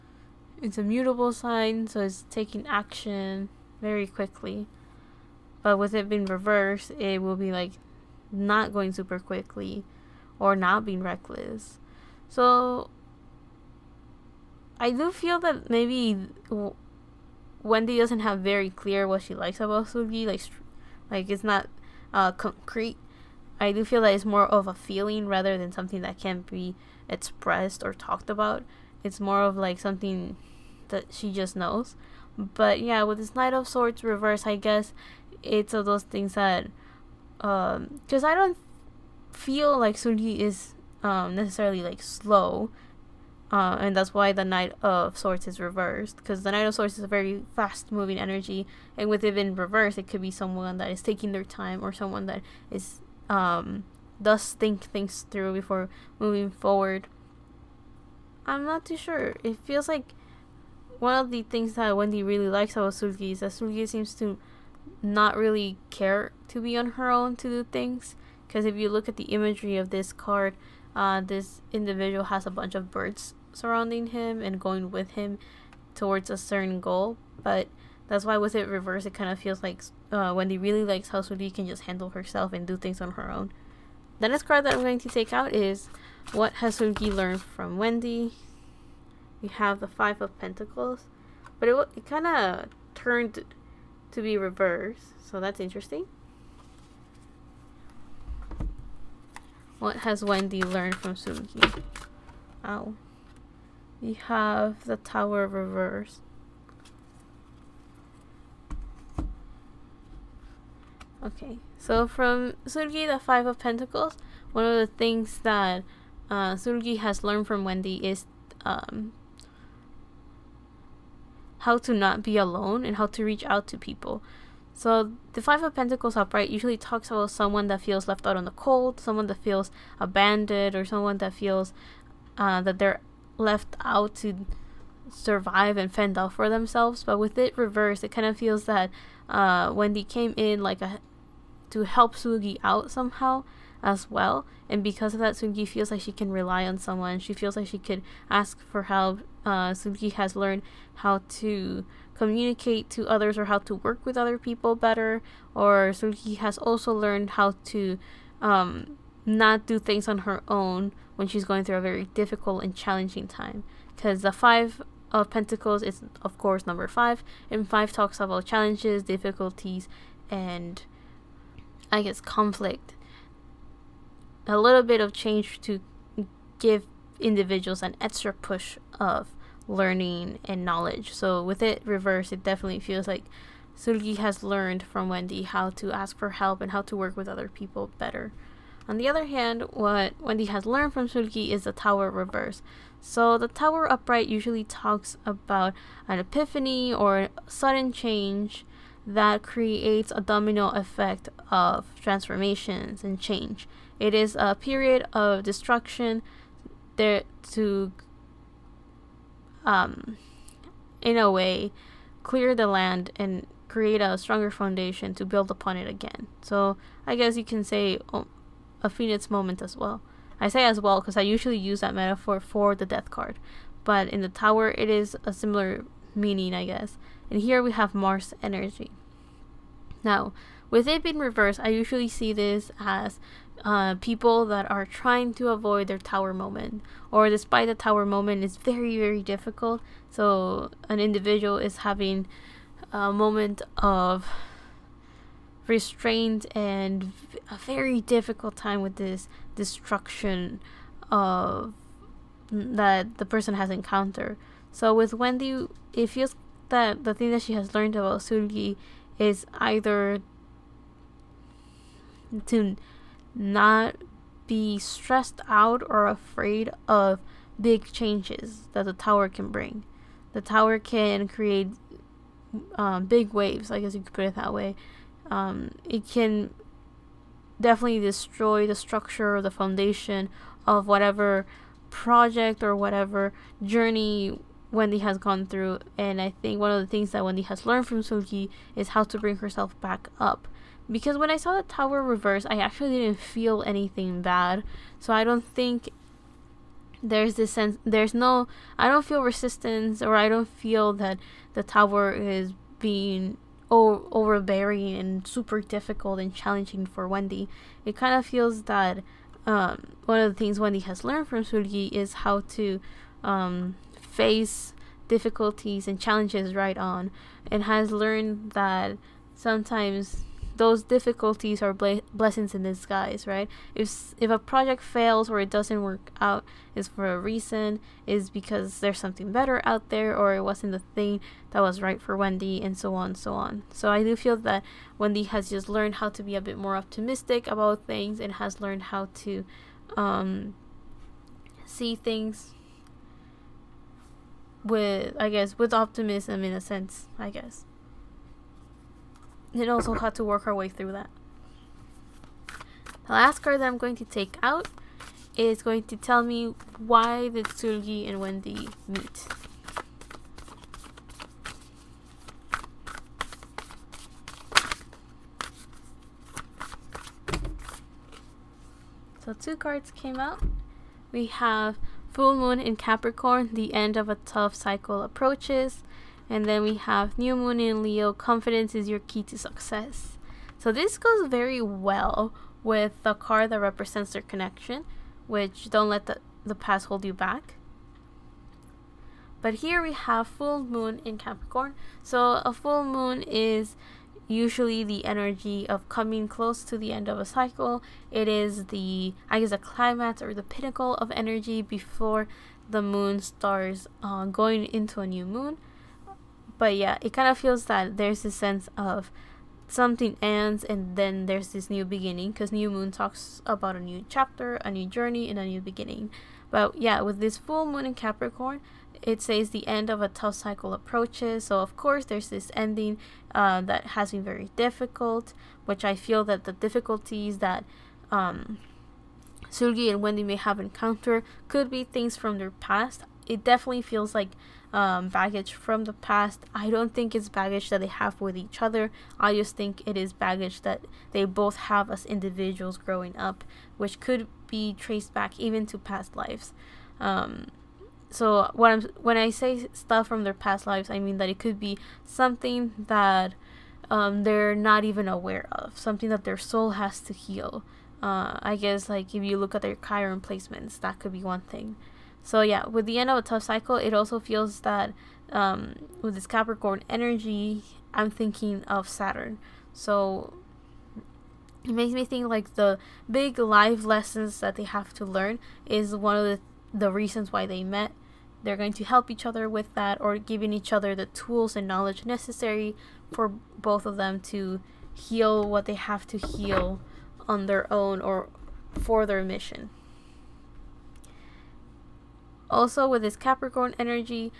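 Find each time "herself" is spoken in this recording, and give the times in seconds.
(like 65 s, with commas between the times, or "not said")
82 s, 289 s.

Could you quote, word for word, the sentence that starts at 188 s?
On the other hand, what Wendy has learned from Seulgi is the tower reverse.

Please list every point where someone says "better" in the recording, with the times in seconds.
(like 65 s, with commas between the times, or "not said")
154 s, 187 s, 329 s.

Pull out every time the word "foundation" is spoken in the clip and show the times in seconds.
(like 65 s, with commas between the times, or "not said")
214 s, 279 s.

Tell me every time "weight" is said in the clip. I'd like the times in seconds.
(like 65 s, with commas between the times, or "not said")
not said.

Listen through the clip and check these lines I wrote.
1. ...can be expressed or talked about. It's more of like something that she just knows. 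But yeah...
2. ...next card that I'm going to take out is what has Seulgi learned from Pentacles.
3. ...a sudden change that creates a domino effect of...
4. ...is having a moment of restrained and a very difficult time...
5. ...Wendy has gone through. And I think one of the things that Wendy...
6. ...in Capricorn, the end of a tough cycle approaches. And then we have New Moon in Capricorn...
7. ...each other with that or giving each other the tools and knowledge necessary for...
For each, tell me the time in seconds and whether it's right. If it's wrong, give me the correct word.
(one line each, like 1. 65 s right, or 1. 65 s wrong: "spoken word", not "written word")
1. 26 s right
2. 84 s wrong: "Wendy", not "Pentacles"
3. 197 s right
4. 241 s right
5. 284 s right
6. 372 s wrong: "Leo", not "Capricorn"
7. 479 s right.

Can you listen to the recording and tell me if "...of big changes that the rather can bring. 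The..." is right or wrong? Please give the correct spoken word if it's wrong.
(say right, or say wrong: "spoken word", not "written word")
wrong: "tower", not "rather".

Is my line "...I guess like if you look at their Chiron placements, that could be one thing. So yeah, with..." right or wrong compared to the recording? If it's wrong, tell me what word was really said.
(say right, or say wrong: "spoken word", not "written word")
right.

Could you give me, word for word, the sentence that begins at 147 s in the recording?
She feels like she could ask for help.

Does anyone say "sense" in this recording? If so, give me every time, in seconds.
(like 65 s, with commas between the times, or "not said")
297 s, 346 s, 408 s.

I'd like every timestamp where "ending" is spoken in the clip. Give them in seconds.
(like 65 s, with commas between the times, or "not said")
422 s.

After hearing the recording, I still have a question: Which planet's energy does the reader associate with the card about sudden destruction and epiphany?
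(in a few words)
Mars.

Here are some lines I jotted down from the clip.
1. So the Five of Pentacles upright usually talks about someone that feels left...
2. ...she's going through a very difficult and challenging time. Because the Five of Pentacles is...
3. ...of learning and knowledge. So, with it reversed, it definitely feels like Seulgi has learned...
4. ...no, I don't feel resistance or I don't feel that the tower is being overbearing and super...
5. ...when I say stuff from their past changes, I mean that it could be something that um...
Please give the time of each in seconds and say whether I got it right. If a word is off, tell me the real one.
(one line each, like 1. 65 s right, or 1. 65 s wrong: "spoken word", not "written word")
1. 124 s right
2. 161 s right
3. 178 s right
4. 298 s right
5. 449 s wrong: "lives", not "changes".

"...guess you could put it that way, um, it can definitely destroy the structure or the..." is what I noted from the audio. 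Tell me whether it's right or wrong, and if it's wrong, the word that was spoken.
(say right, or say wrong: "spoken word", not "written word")
right.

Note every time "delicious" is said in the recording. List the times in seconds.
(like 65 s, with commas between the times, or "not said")
not said.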